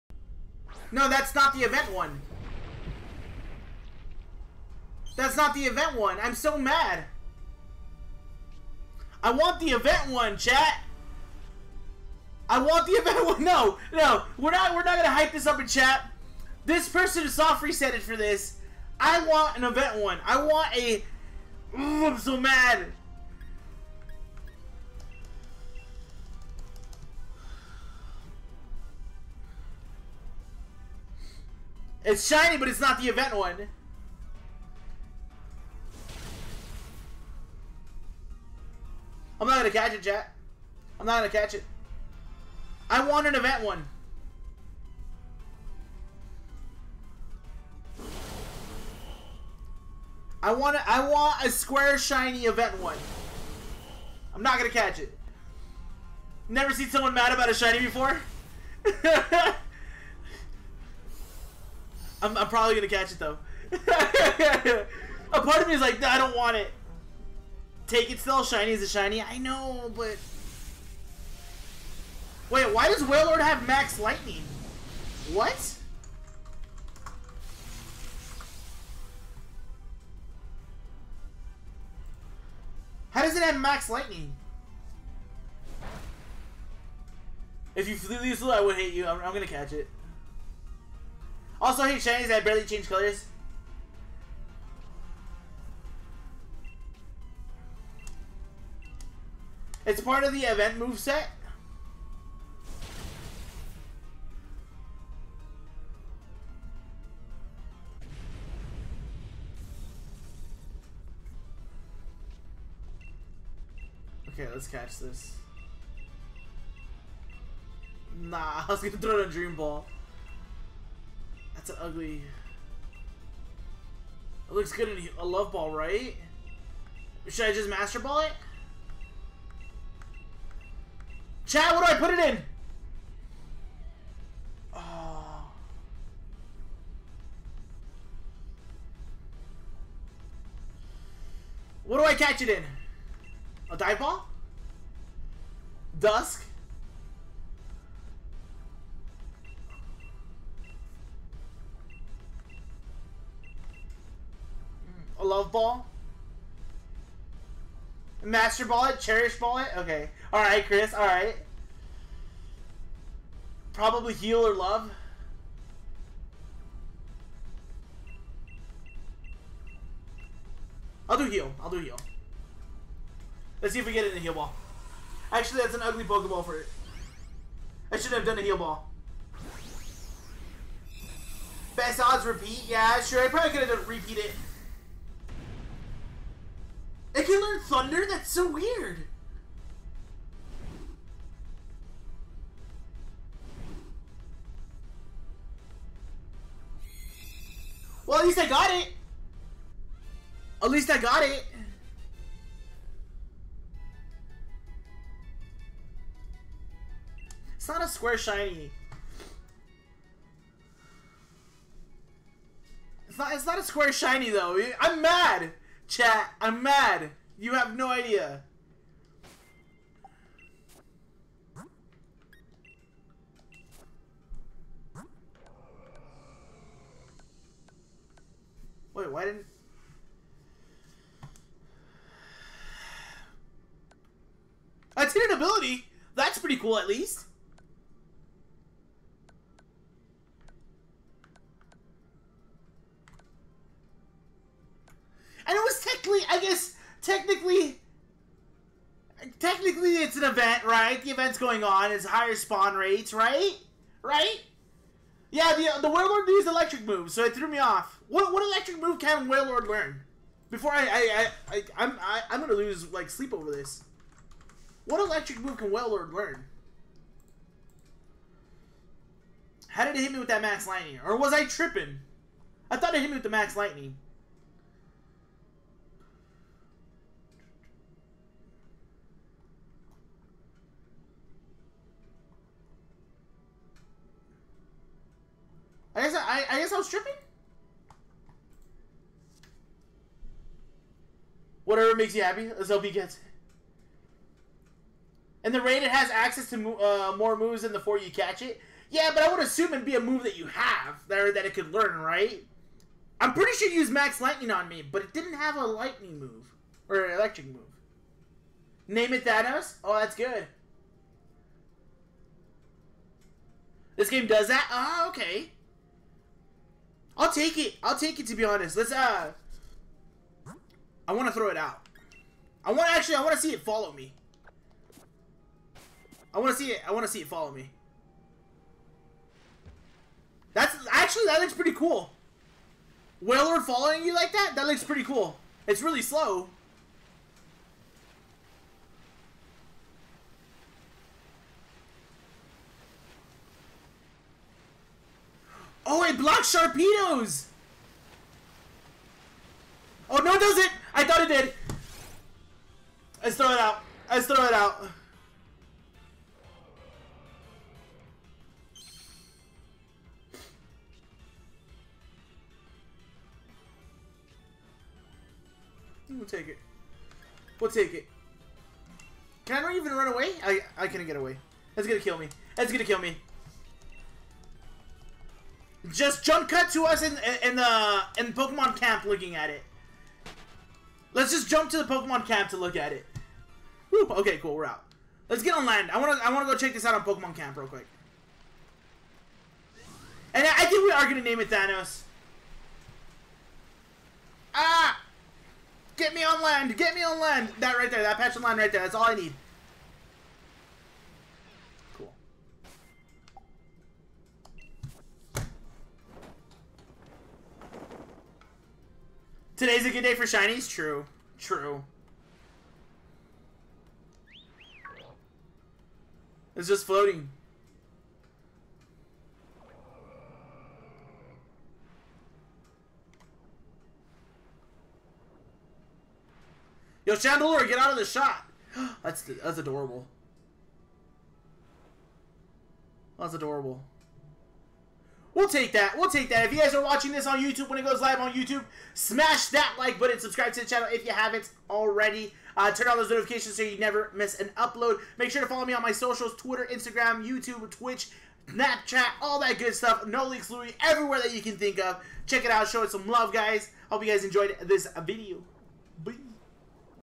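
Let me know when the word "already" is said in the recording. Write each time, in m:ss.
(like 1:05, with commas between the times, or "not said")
7:21.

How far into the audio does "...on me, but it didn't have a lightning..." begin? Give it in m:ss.
5:04.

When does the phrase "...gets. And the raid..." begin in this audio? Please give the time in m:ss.
4:52.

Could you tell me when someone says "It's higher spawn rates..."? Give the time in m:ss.
4:11.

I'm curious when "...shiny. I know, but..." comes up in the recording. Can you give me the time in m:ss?
1:08.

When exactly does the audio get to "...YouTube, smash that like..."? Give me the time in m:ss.
7:18.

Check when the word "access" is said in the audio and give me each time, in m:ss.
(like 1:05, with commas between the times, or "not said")
4:56.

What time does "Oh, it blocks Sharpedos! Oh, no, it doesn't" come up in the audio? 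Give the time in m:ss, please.
5:45.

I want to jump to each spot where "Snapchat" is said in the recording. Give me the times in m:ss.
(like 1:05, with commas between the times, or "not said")
7:28.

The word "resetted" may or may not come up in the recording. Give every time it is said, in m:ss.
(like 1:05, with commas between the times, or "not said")
0:17.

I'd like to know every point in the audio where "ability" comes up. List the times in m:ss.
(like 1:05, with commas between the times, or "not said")
3:55.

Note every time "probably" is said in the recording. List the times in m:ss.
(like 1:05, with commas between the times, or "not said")
1:02, 2:43, 3:03.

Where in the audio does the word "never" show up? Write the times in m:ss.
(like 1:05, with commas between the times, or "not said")
0:56, 7:23.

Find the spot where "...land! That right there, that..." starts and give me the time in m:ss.
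6:37.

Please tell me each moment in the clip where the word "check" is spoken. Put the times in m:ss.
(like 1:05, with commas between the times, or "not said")
6:26, 7:32.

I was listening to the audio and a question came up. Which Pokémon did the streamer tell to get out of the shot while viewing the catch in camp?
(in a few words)
Chandelure.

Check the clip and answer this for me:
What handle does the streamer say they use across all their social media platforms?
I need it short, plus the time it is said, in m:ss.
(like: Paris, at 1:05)
No Leaks Louiee, at 7:30.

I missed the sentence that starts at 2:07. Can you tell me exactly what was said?
Should I just master ball it?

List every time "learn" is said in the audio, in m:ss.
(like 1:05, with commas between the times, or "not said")
3:07, 4:19, 4:26, 5:01.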